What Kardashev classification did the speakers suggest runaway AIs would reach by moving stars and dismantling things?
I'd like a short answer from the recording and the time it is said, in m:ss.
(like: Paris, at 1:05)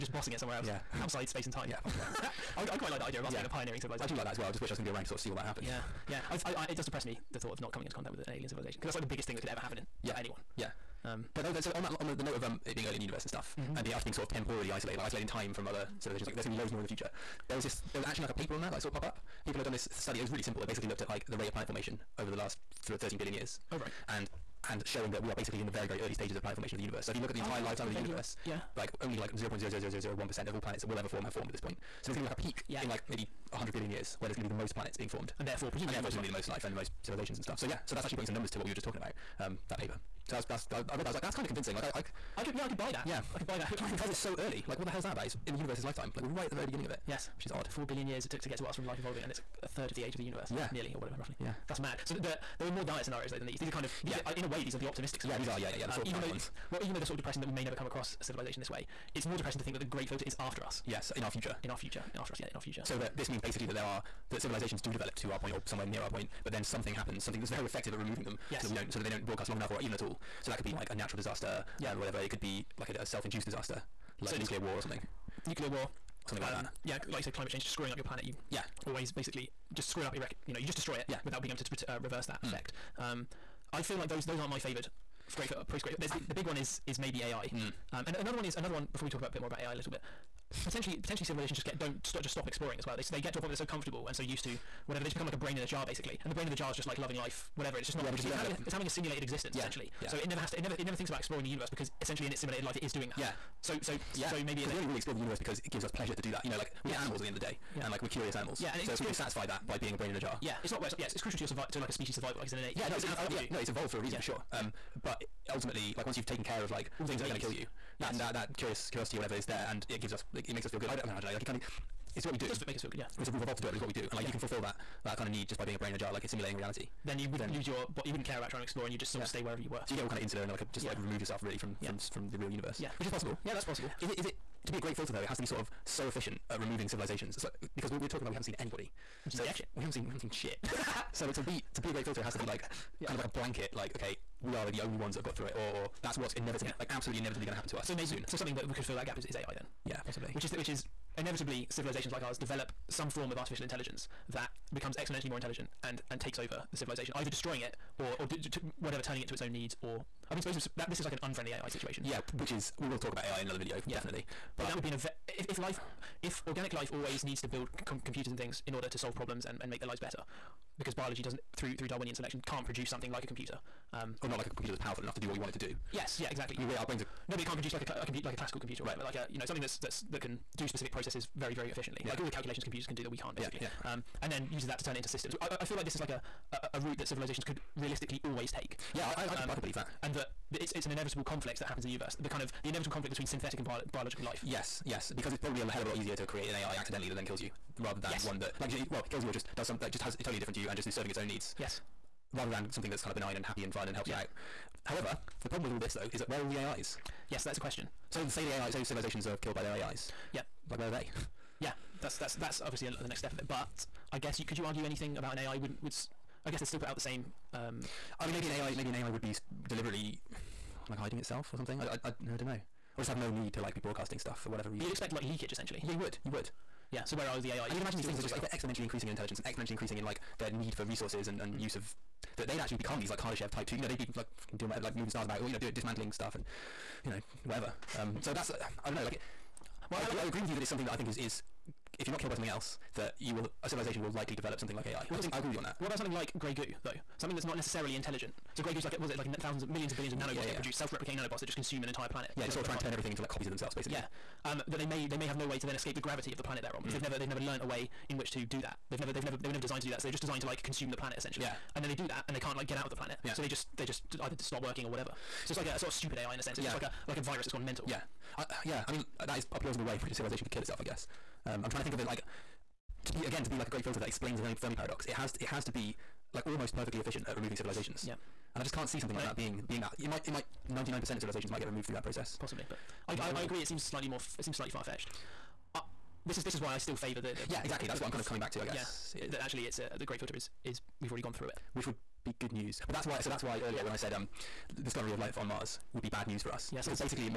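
Type two, at 3:53.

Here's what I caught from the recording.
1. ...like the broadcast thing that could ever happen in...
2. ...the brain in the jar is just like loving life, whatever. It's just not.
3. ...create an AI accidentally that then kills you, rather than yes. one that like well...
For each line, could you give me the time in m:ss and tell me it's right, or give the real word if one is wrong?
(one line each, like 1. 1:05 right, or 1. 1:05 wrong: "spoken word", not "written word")
1. 0:08 wrong: "biggest", not "broadcast"
2. 1:36 right
3. 3:16 right.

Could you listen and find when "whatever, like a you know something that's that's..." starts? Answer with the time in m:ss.
2:58.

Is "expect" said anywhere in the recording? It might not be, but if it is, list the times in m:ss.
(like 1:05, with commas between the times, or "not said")
3:44.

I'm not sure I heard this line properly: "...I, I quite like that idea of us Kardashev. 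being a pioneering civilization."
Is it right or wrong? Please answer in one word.
wrong.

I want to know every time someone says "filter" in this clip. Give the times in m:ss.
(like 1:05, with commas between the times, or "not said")
1:00, 2:14, 2:22, 4:33, 4:50.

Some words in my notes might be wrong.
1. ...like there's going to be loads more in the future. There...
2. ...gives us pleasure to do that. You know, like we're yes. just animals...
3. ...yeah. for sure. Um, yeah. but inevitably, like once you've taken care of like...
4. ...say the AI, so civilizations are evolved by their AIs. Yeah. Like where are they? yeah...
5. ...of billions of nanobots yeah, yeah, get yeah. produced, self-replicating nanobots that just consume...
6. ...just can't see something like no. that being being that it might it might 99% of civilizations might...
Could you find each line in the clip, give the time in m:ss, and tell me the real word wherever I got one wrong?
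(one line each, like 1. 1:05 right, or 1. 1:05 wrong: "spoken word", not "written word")
1. 0:16 right
2. 1:45 right
3. 1:54 wrong: "ultimately", not "inevitably"
4. 3:28 wrong: "killed", not "evolved"
5. 4:09 right
6. 4:38 right.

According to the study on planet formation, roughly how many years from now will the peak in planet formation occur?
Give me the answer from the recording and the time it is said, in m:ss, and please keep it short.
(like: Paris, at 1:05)
100 billion years, at 0:33.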